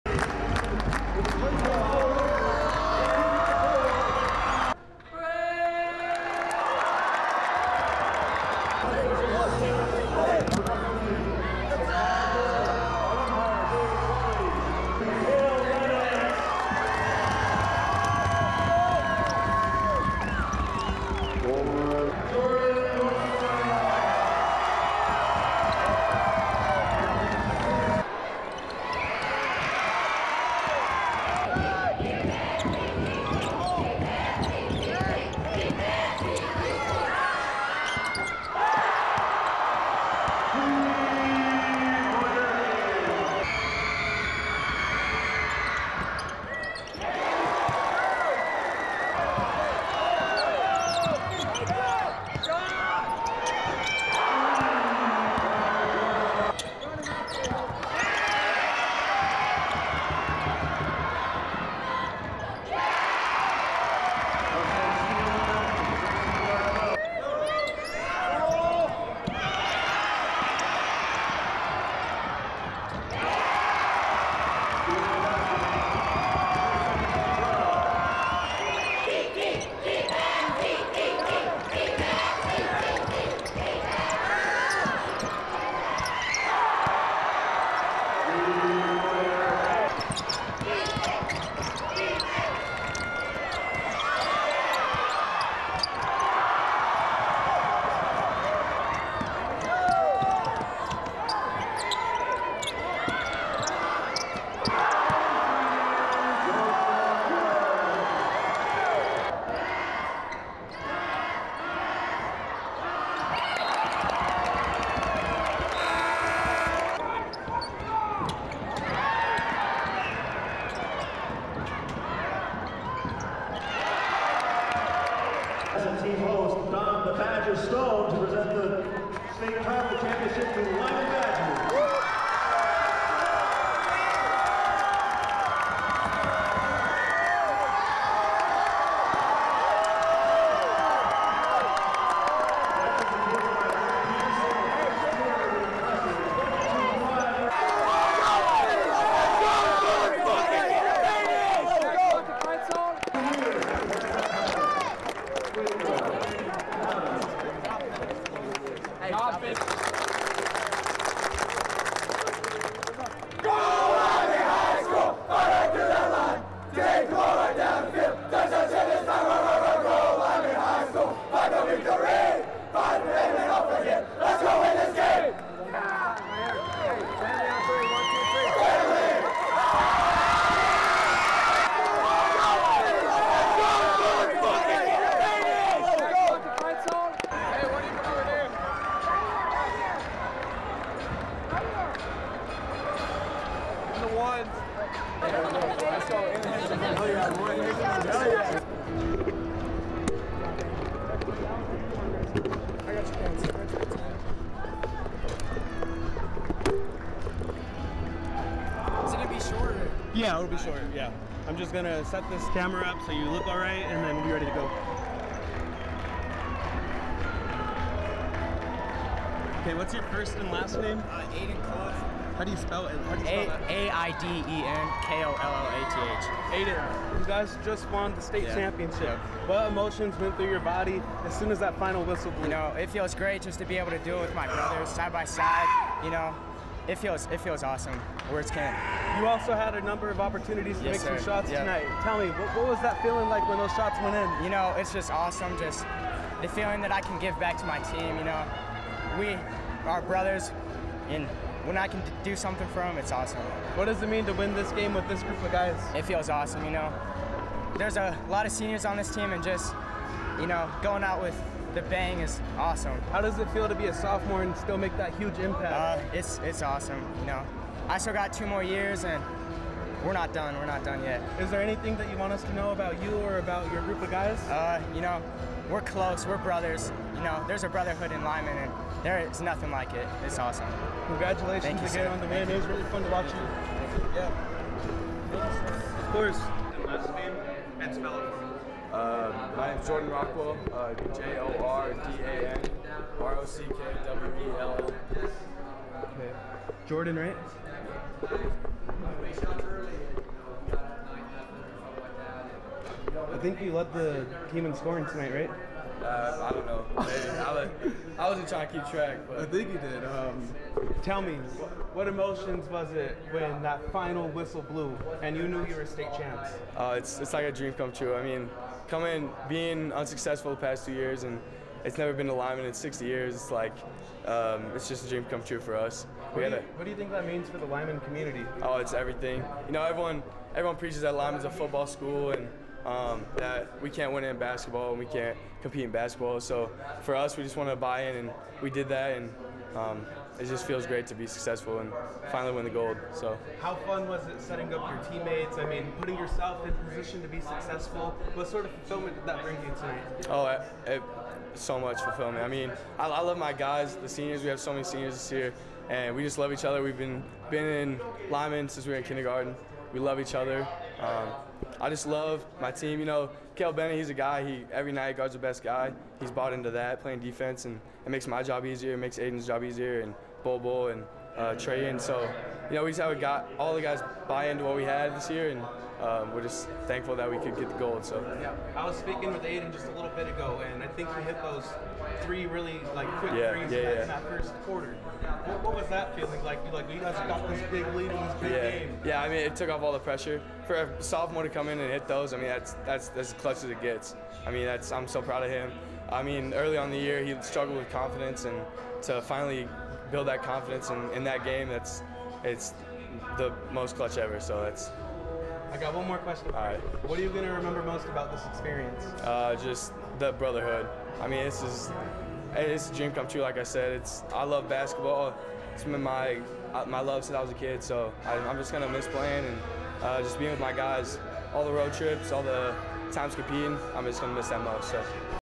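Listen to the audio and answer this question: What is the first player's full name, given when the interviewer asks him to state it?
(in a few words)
Aiden Clough.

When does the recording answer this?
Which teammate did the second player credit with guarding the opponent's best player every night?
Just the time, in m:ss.
6:03.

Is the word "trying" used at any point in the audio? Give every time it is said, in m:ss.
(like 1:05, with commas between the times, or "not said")
5:08.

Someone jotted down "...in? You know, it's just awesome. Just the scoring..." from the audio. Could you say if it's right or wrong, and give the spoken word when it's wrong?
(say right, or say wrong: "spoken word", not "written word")
wrong: "feeling", not "scoring".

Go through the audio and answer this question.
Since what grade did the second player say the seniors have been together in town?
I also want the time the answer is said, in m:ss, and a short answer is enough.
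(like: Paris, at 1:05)
Kindergarten, at 5:59.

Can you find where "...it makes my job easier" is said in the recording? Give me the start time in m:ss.
6:08.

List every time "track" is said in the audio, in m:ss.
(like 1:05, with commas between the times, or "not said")
5:08.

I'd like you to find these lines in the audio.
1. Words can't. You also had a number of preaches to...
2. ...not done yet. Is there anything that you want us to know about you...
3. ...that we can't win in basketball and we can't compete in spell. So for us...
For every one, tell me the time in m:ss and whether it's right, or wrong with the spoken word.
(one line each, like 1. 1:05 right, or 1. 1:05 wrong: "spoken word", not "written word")
1. 3:58 wrong: "opportunities", not "preaches"
2. 4:30 right
3. 5:33 wrong: "basketball", not "spell".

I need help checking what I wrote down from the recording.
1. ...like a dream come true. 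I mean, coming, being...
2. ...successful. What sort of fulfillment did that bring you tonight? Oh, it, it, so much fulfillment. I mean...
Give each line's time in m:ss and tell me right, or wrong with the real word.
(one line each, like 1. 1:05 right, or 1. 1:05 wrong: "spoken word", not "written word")
1. 5:17 right
2. 5:47 right.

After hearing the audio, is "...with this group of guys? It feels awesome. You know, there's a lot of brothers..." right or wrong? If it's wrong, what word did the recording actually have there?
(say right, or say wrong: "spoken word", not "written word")
wrong: "seniors", not "brothers".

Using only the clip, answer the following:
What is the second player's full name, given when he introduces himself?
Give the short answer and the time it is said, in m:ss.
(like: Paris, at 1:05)
Jordan Rockwell, at 4:49.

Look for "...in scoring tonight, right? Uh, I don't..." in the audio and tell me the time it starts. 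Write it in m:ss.
5:04.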